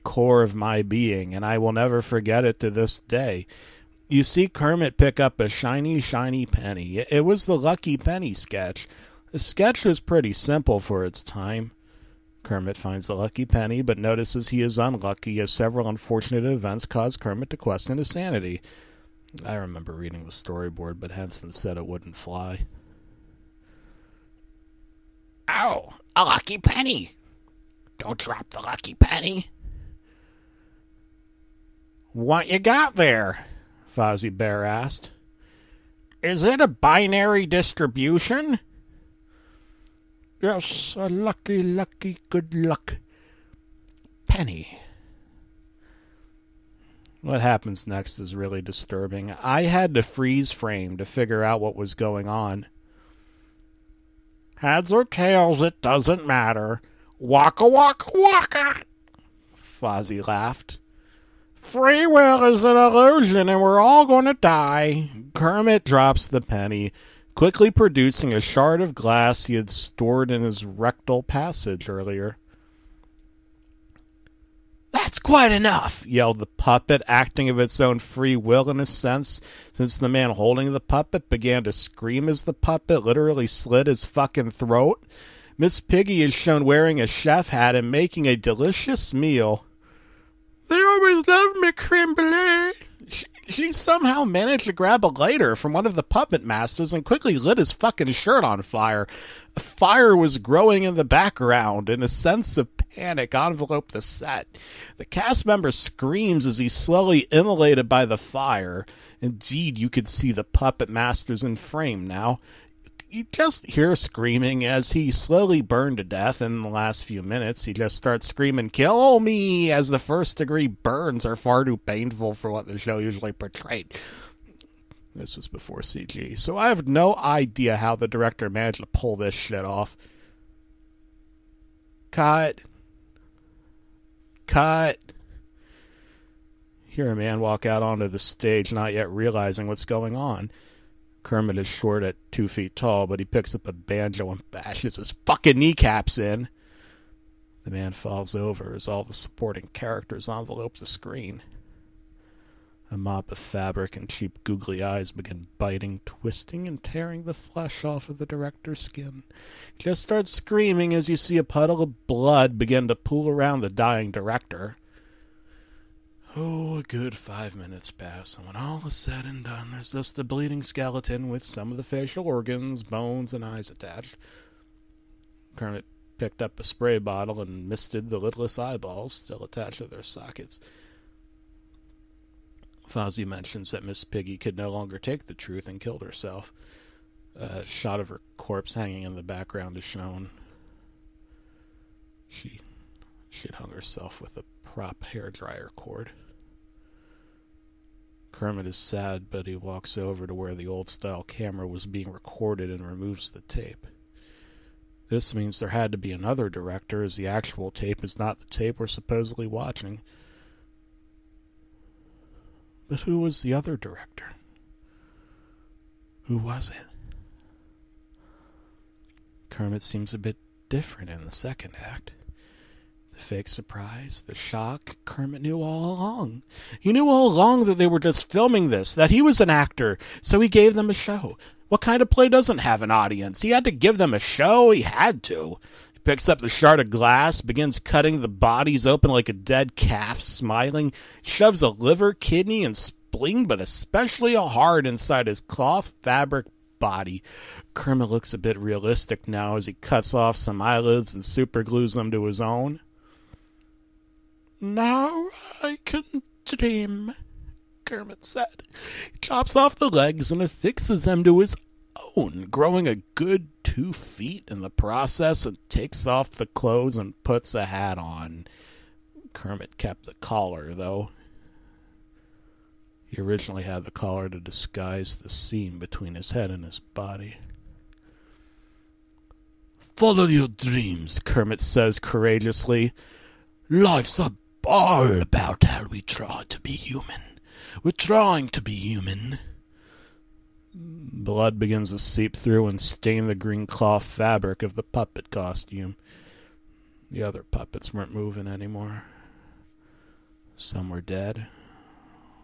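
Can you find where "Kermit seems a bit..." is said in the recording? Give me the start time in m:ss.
3:39.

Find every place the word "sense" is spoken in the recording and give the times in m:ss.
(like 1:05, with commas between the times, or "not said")
1:18, 1:42.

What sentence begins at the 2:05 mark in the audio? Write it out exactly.
This was before CG, so I have no idea how the director managed to pull this shit off.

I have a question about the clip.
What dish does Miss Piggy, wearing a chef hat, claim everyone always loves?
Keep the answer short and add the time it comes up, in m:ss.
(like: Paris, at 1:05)
creme brulee, at 1:31.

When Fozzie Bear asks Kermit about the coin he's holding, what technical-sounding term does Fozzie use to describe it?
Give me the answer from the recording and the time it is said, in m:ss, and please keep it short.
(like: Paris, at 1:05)
binary distribution, at 0:36.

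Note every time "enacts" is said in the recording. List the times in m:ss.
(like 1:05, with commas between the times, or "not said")
not said.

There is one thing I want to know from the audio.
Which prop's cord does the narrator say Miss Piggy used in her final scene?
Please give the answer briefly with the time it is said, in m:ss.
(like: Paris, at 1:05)
hair dryer, at 3:15.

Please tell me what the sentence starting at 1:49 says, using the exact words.
Indeed, you could see the puppet master's in frame now.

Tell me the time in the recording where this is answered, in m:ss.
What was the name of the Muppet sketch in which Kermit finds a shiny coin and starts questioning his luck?
0:07.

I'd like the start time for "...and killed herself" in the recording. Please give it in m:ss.
3:05.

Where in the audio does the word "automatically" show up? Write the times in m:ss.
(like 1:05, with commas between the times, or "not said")
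not said.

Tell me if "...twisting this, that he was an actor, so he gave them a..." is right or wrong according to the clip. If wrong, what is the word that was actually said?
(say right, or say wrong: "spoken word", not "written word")
wrong: "filming", not "twisting".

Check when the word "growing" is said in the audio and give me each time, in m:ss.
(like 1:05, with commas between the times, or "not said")
1:40, 4:22.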